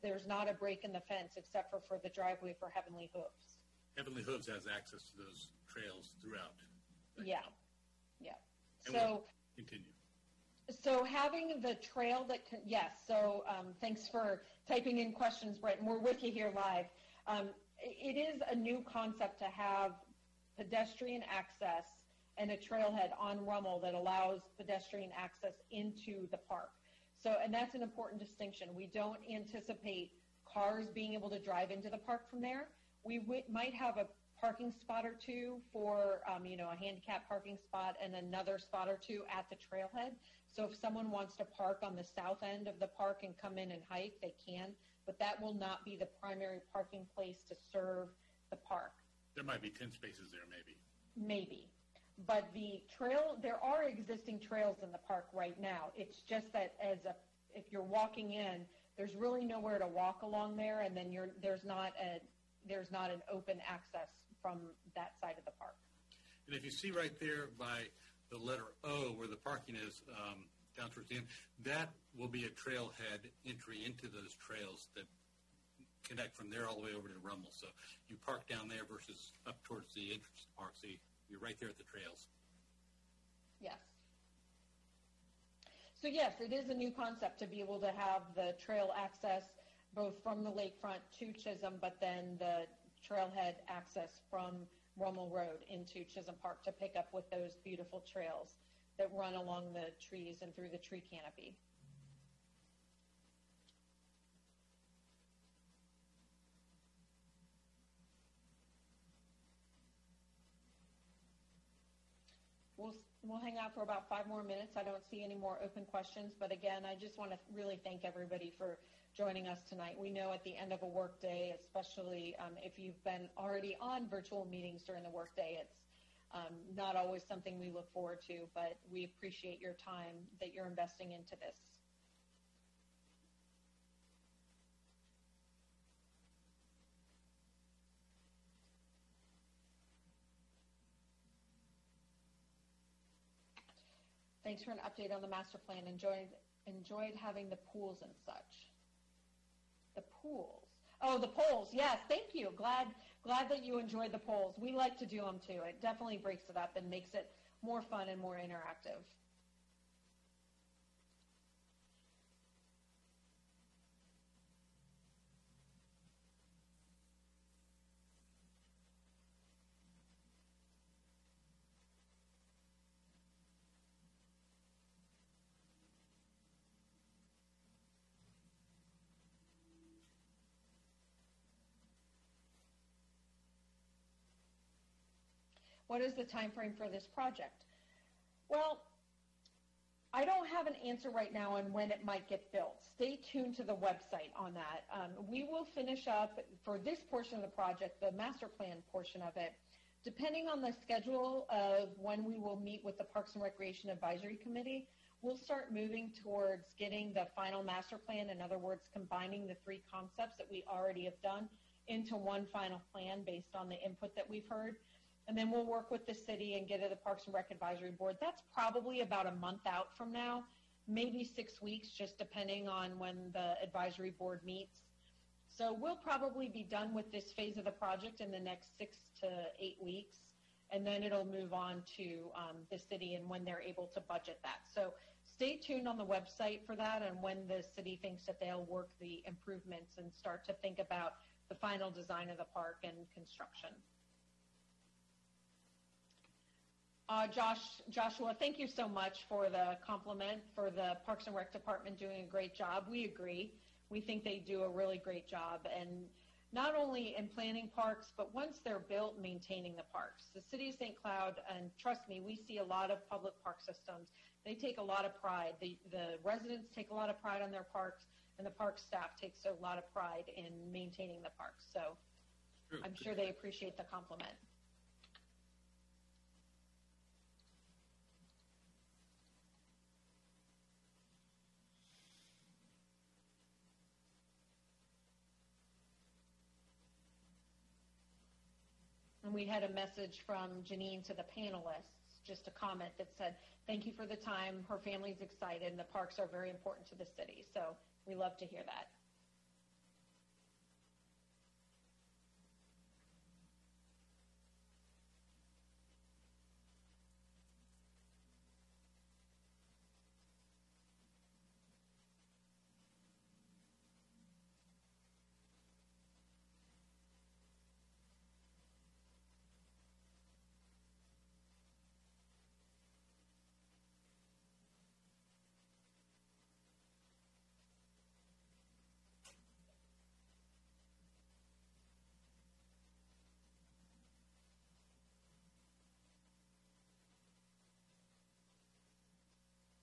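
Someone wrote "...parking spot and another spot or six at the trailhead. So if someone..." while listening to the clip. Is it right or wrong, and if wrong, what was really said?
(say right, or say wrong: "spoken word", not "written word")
wrong: "two", not "six".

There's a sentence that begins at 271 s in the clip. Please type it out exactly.
So I'm sure they appreciate the compliment.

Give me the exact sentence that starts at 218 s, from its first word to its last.
That's probably about a month out from now, maybe six weeks, just depending on when the advisory board meets.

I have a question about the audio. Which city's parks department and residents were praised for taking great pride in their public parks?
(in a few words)
St. Cloud.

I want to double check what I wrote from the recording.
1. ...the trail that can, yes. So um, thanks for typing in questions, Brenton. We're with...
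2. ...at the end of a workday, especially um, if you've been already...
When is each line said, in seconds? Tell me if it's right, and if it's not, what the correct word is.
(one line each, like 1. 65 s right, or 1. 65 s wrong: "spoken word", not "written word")
1. 11 s right
2. 120 s right.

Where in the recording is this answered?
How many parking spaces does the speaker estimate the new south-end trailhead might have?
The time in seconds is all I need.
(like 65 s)
49 s.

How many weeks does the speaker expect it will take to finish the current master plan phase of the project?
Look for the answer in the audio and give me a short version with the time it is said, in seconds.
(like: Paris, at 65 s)
6 to 8 weeks, at 228 s.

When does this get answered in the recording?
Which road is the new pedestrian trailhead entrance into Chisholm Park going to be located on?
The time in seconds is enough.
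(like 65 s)
94 s.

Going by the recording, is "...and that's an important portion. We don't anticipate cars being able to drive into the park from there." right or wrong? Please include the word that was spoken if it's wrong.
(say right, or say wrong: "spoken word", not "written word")
wrong: "distinction", not "portion".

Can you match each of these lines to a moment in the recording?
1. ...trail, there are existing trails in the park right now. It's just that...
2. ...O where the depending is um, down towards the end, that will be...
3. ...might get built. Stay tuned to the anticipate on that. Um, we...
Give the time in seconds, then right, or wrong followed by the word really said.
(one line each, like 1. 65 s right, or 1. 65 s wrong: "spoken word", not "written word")
1. 52 s right
2. 68 s wrong: "parking", not "depending"
3. 192 s wrong: "website", not "anticipate".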